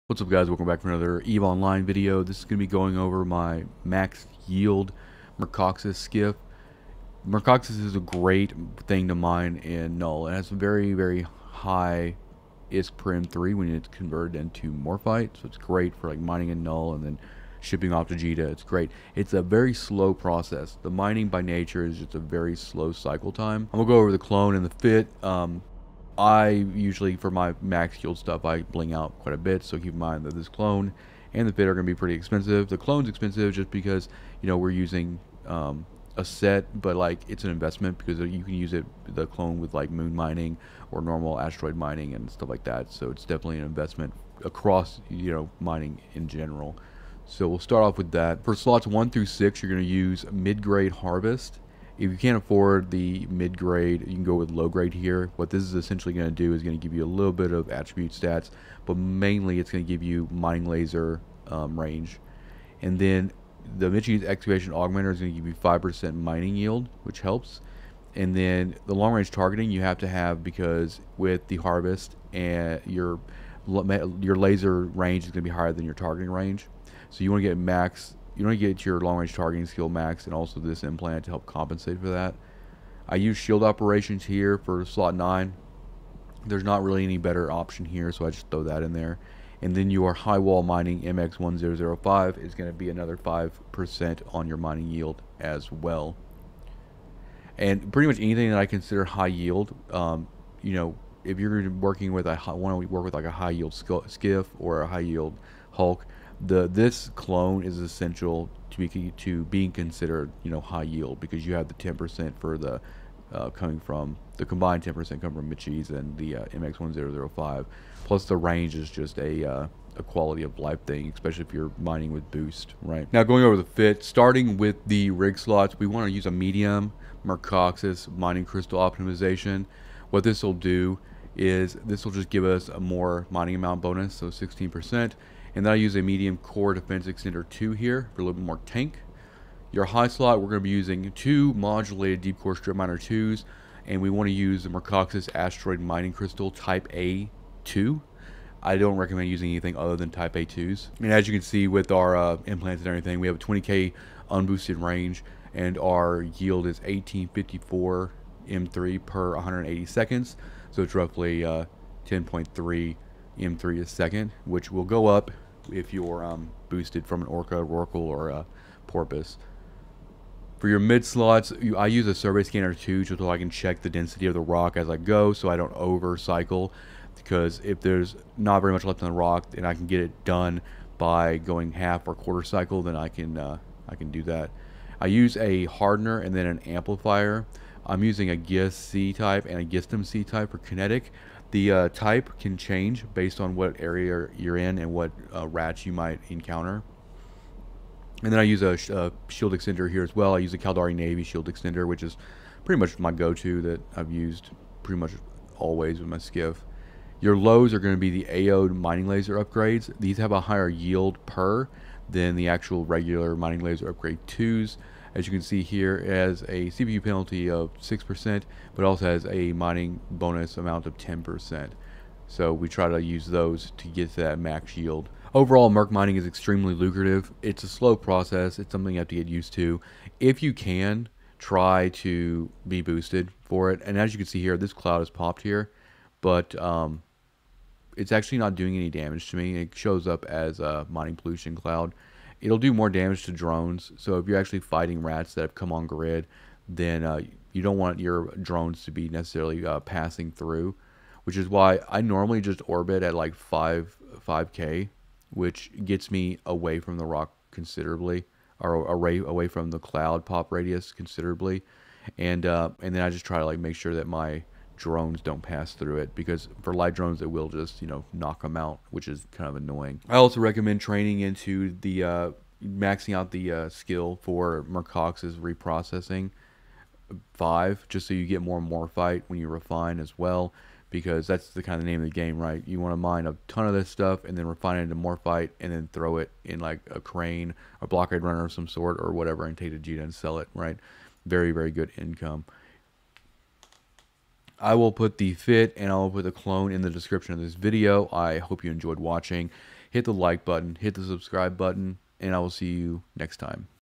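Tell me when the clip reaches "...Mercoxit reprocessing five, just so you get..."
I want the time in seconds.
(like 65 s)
274 s.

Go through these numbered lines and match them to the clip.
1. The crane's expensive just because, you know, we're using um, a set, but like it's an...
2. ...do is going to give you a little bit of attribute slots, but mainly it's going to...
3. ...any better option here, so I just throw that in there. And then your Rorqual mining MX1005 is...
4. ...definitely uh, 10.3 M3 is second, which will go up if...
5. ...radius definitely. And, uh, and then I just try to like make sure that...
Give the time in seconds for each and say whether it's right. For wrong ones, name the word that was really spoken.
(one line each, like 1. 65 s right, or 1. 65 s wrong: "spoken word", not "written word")
1. 32 s wrong: "clone", not "crane"
2. 56 s wrong: "stats", not "slots"
3. 87 s wrong: "Highwall", not "Rorqual"
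4. 160 s wrong: "roughly", not "definitely"
5. 260 s wrong: "considerably", not "definitely".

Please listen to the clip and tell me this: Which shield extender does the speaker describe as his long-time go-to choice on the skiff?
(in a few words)
Caldari Navy shield extender.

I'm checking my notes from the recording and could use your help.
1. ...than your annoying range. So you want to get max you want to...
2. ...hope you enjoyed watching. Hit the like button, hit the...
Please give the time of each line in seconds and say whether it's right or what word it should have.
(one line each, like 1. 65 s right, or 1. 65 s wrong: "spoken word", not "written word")
1. 75 s wrong: "targeting", not "annoying"
2. 298 s right.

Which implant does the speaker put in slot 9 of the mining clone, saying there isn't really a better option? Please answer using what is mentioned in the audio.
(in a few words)
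Shield operations.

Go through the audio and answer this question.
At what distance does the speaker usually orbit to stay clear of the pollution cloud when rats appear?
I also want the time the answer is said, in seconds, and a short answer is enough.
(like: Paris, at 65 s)
5k, at 253 s.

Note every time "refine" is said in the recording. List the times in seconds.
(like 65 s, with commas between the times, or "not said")
279 s, 284 s.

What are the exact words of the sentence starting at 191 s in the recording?
The uh, type can change based on what area you're in and what uh, rats you might encounter.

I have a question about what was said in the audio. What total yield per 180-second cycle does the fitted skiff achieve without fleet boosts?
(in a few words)
1854 m3.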